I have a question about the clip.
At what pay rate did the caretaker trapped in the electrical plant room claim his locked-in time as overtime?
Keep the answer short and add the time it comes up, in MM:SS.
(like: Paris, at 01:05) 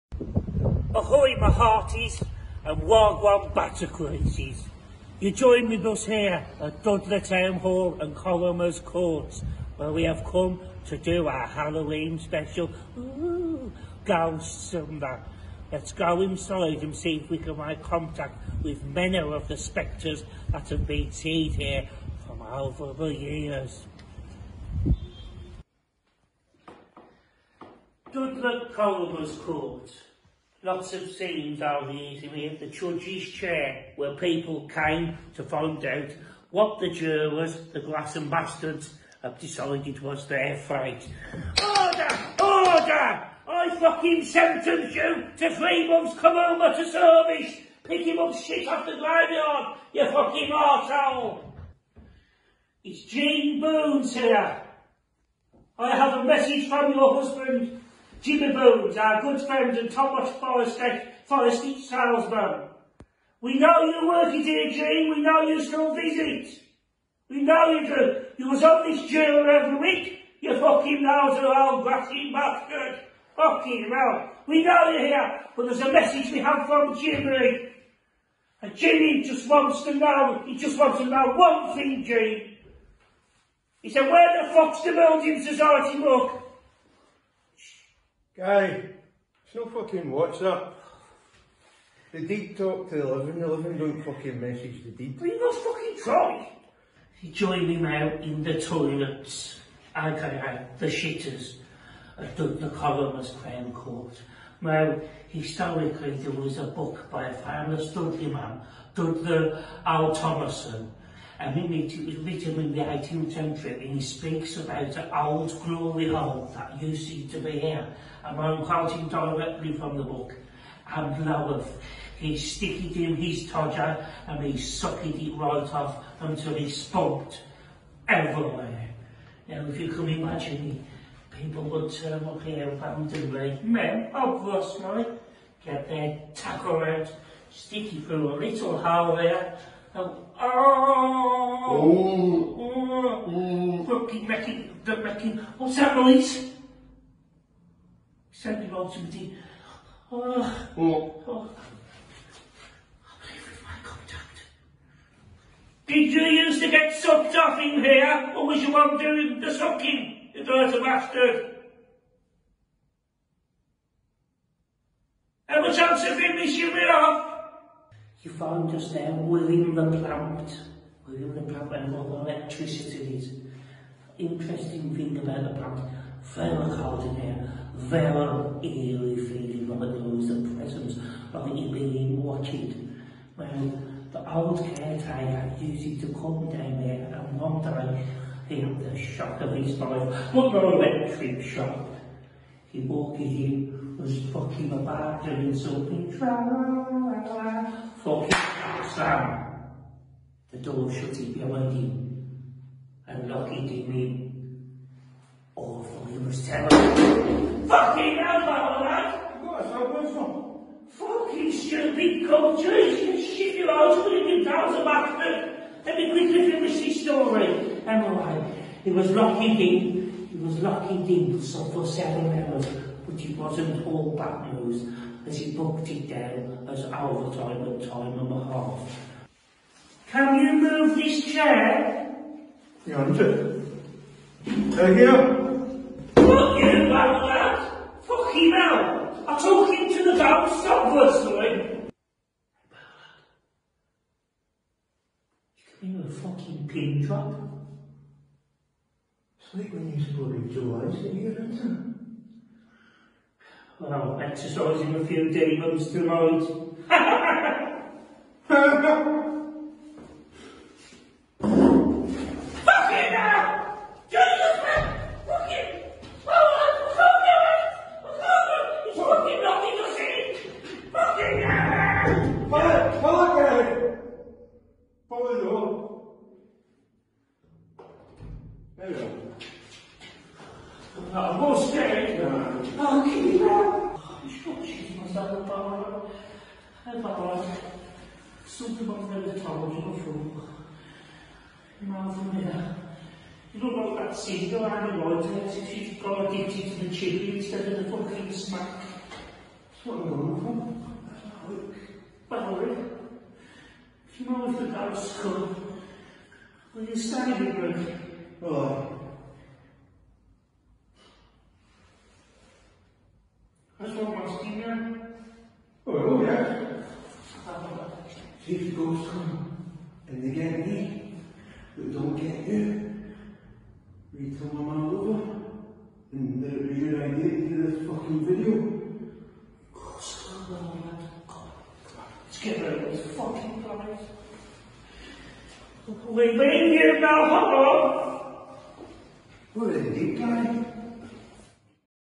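time and a half, at 03:47.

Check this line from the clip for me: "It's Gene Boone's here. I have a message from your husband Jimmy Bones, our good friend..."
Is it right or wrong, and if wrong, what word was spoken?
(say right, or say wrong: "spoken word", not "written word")
right.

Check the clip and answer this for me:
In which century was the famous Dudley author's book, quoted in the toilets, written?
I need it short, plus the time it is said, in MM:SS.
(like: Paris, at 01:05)
18th century, at 01:52.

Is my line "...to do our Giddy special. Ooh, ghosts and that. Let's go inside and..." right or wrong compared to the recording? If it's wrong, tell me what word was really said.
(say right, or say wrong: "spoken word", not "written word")
wrong: "Halloween", not "Giddy".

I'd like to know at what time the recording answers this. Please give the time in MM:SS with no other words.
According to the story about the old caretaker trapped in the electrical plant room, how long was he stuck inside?
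03:41.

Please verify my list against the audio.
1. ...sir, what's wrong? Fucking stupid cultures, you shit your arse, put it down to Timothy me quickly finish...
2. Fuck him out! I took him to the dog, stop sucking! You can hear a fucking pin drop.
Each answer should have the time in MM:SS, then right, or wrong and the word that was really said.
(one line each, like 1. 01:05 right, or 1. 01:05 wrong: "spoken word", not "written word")
1. 03:29 wrong: "Let", not "Timothy"
2. 03:58 wrong: "whistling", not "sucking".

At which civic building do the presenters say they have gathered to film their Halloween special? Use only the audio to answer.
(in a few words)
Dudley Town Hall.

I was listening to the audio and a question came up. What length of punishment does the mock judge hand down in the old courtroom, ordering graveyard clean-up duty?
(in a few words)
3 months.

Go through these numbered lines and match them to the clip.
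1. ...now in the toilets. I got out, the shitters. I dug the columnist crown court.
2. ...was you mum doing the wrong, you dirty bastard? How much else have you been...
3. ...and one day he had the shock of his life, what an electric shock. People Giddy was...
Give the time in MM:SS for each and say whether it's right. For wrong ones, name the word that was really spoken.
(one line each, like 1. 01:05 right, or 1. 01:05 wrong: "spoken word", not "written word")
1. 01:37 right
2. 02:38 wrong: "sucking", not "wrong"
3. 03:07 right.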